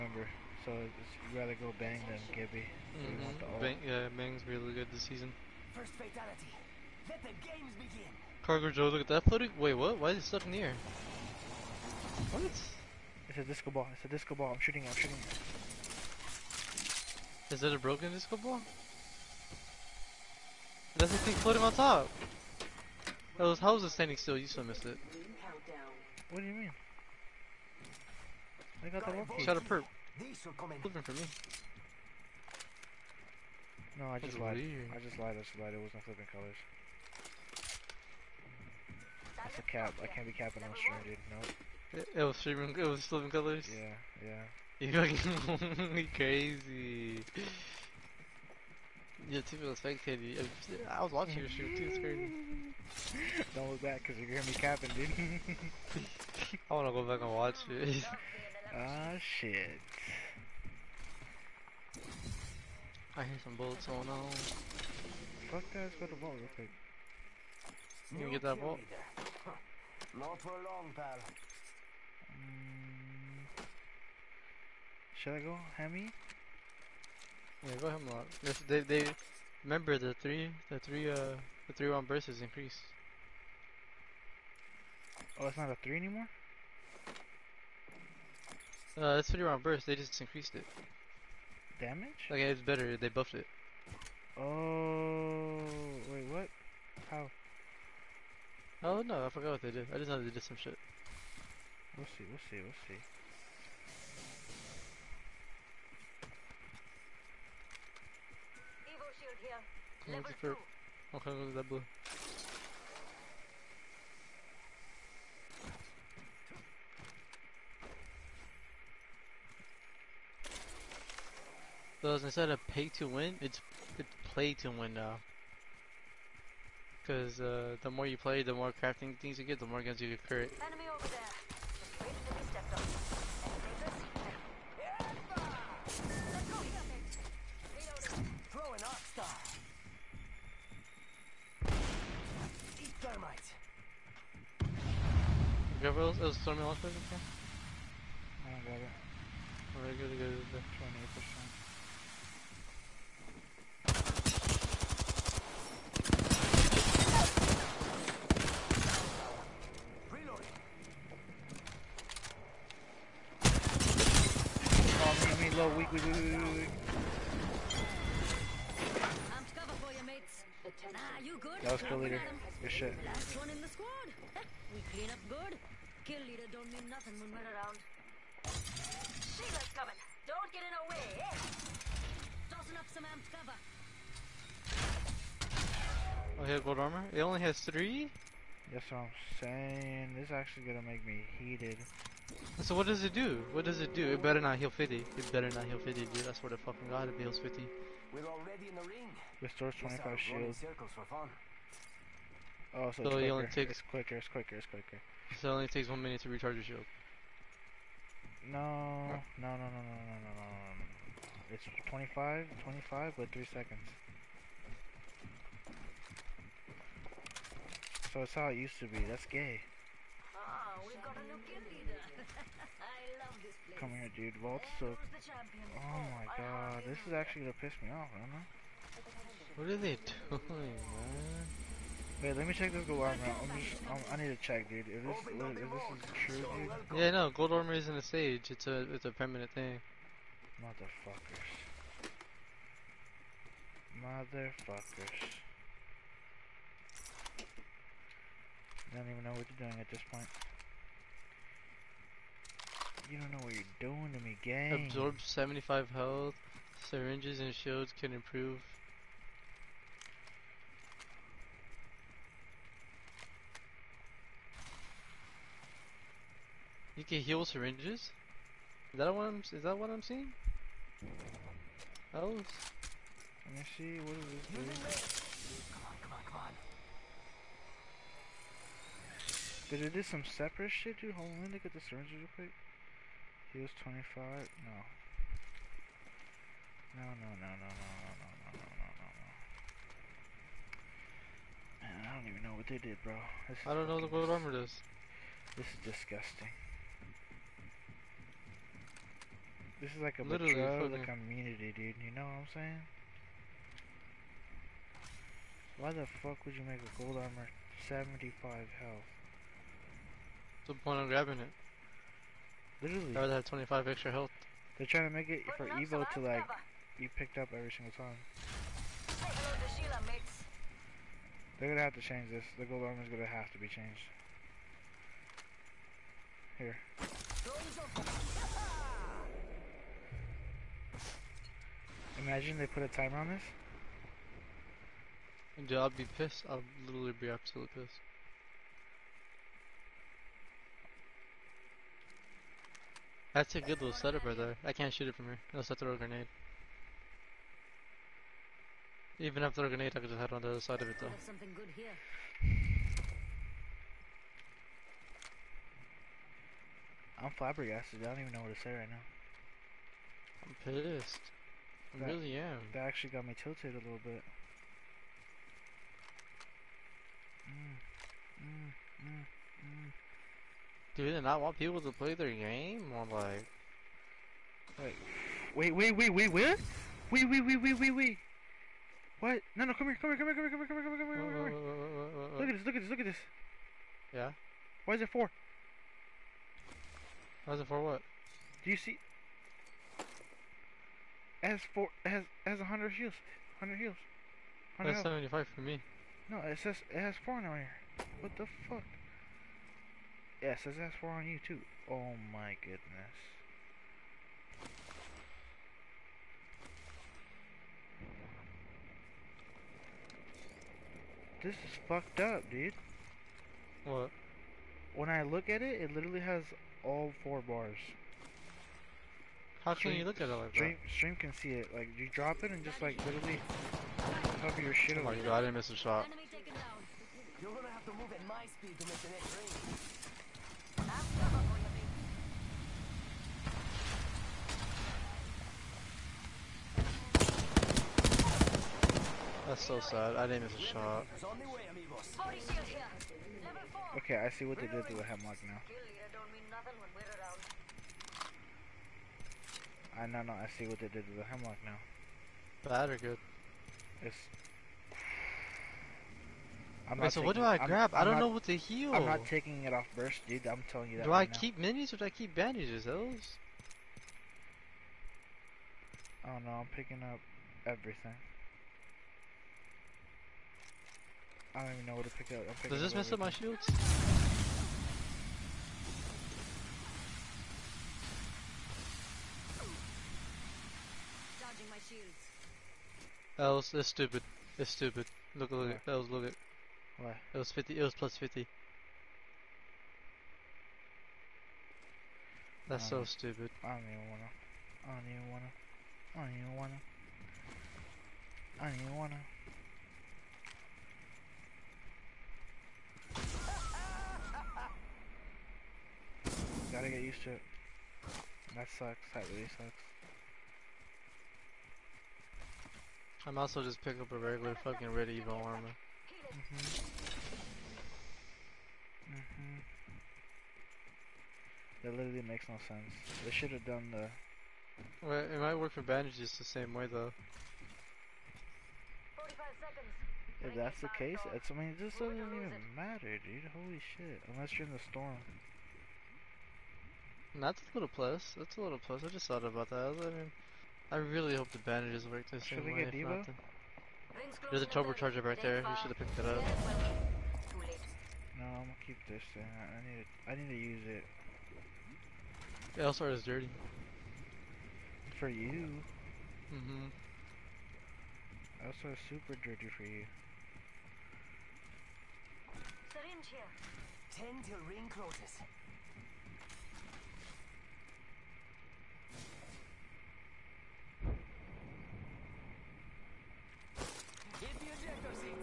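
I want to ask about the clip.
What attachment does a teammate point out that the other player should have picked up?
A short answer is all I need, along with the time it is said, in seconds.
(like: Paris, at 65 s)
Turbocharger, at 544 s.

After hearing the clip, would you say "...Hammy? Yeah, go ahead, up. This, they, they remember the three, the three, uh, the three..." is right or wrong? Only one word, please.
right.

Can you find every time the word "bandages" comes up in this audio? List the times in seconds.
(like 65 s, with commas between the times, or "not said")
462 s, 525 s, 541 s.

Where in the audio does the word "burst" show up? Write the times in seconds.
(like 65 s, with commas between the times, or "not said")
82 s, 89 s, 459 s.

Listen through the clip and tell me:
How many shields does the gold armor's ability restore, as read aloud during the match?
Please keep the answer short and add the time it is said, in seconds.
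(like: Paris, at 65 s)
25, at 199 s.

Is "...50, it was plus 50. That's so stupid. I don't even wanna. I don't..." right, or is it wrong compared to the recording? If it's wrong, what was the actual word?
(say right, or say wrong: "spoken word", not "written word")
right.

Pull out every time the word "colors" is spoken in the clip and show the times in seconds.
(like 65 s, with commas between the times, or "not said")
36 s, 43 s.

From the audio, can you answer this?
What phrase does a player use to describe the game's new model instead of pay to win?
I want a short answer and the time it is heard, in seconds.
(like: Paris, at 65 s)
Play to win, at 124 s.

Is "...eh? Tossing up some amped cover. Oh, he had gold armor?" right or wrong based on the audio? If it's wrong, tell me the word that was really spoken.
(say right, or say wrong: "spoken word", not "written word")
right.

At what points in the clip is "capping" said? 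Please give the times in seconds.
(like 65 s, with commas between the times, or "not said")
40 s, 54 s.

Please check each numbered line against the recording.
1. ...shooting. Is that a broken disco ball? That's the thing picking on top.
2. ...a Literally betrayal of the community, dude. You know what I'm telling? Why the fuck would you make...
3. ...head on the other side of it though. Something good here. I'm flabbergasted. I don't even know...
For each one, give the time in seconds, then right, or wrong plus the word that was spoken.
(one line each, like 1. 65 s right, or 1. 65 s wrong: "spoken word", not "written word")
1. 15 s wrong: "floating", not "picking"
2. 300 s wrong: "saying", not "telling"
3. 350 s right.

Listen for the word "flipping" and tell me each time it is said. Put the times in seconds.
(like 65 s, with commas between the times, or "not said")
36 s, 43 s.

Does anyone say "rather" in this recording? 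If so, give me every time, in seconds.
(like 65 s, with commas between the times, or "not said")
1 s, 313 s.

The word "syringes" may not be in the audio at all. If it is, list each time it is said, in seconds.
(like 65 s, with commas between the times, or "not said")
256 s, 267 s, 281 s, 562 s.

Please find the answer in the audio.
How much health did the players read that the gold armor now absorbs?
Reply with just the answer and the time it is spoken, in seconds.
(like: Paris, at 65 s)
75, at 254 s.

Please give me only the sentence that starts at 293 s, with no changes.
This I don't know what the gold armor does.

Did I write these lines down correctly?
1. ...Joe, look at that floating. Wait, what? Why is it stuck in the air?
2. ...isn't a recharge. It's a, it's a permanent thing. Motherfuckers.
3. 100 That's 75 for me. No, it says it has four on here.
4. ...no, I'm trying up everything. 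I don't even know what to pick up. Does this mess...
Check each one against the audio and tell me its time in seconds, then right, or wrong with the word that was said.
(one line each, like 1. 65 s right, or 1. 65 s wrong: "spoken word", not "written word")
1. 8 s right
2. 237 s wrong: "stage", not "recharge"
3. 394 s right
4. 466 s wrong: "picking", not "trying".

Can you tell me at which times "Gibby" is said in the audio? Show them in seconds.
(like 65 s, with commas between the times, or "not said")
2 s.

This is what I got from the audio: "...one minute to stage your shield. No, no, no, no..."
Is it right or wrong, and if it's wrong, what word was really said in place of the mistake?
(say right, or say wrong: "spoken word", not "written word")
wrong: "recharge", not "stage".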